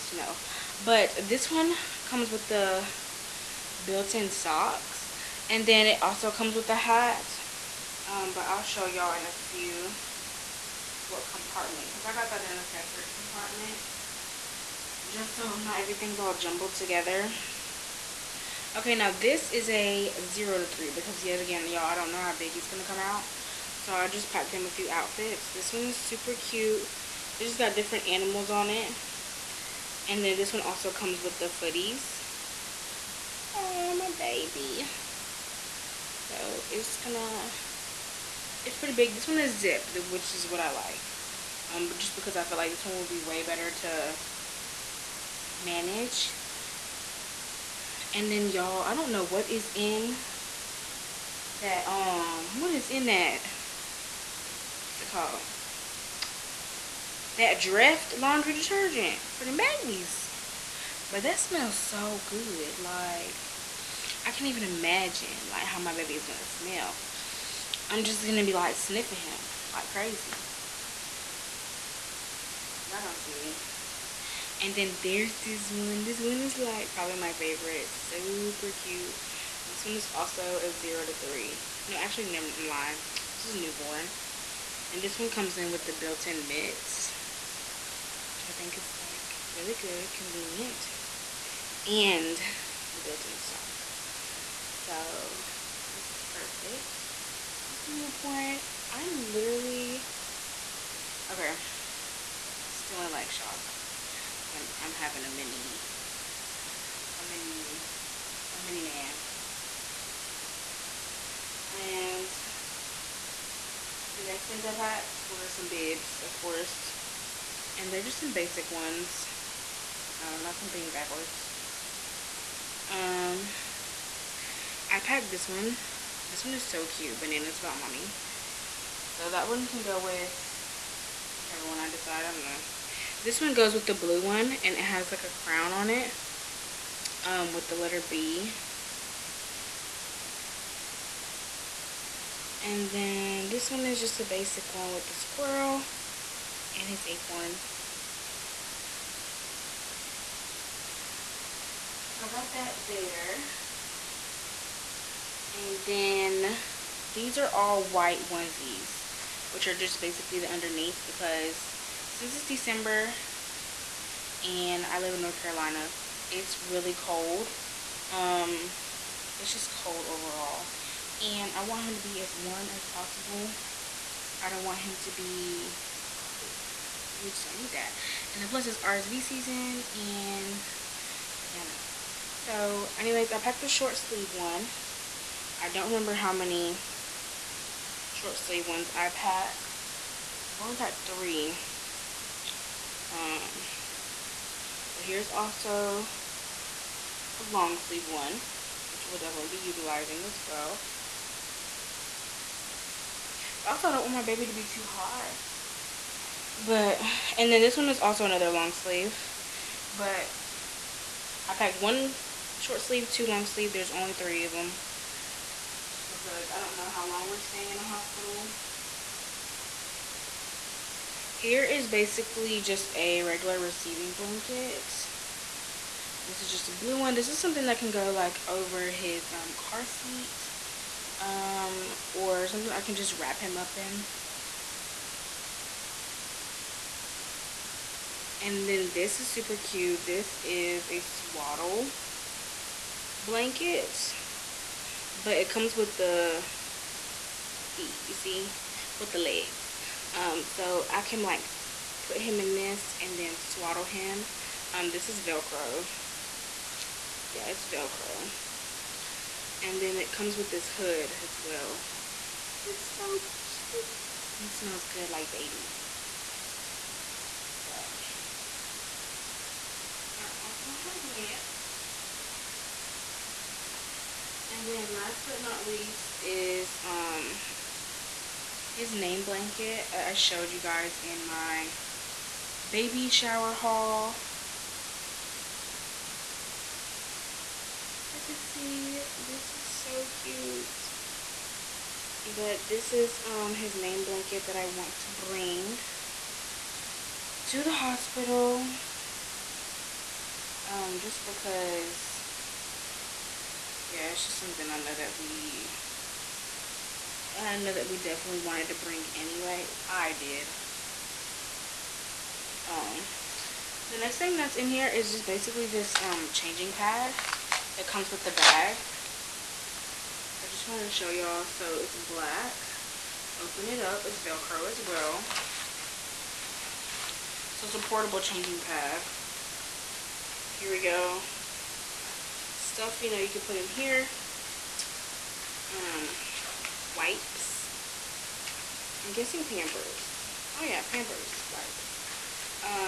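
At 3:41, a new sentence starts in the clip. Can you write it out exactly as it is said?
Here is basically just a regular receiving blanket.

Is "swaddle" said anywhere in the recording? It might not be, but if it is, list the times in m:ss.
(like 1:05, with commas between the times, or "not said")
4:01, 4:13.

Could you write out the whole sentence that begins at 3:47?
This is something that can go like over his um, car seat um, or something I can just wrap him up in.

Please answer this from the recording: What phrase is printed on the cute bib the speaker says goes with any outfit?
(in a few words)
Bananas about mommy.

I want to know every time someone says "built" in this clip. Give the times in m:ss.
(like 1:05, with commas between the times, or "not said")
0:03, 1:25, 1:33.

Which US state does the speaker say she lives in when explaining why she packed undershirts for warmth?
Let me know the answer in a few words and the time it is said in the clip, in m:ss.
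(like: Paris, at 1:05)
North Carolina, at 2:45.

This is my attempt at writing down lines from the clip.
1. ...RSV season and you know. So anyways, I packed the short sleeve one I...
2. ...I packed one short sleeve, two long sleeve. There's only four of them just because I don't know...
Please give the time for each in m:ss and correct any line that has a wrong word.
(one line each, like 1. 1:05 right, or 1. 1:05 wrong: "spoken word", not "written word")
1. 2:58 right
2. 3:31 wrong: "three", not "four".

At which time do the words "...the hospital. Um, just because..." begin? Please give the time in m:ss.
4:57.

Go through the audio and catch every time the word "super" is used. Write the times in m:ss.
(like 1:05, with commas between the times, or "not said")
0:25, 1:17, 3:59.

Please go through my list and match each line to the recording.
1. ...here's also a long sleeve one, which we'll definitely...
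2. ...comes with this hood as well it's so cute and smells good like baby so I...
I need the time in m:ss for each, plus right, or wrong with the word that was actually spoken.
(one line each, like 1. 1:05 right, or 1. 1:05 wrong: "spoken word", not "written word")
1. 3:15 right
2. 4:20 right.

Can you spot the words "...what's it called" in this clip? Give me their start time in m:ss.
0:54.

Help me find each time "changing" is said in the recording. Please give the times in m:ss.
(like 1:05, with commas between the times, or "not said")
5:16, 5:28.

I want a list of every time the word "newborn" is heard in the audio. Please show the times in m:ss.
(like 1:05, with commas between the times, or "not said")
1:23, 1:37.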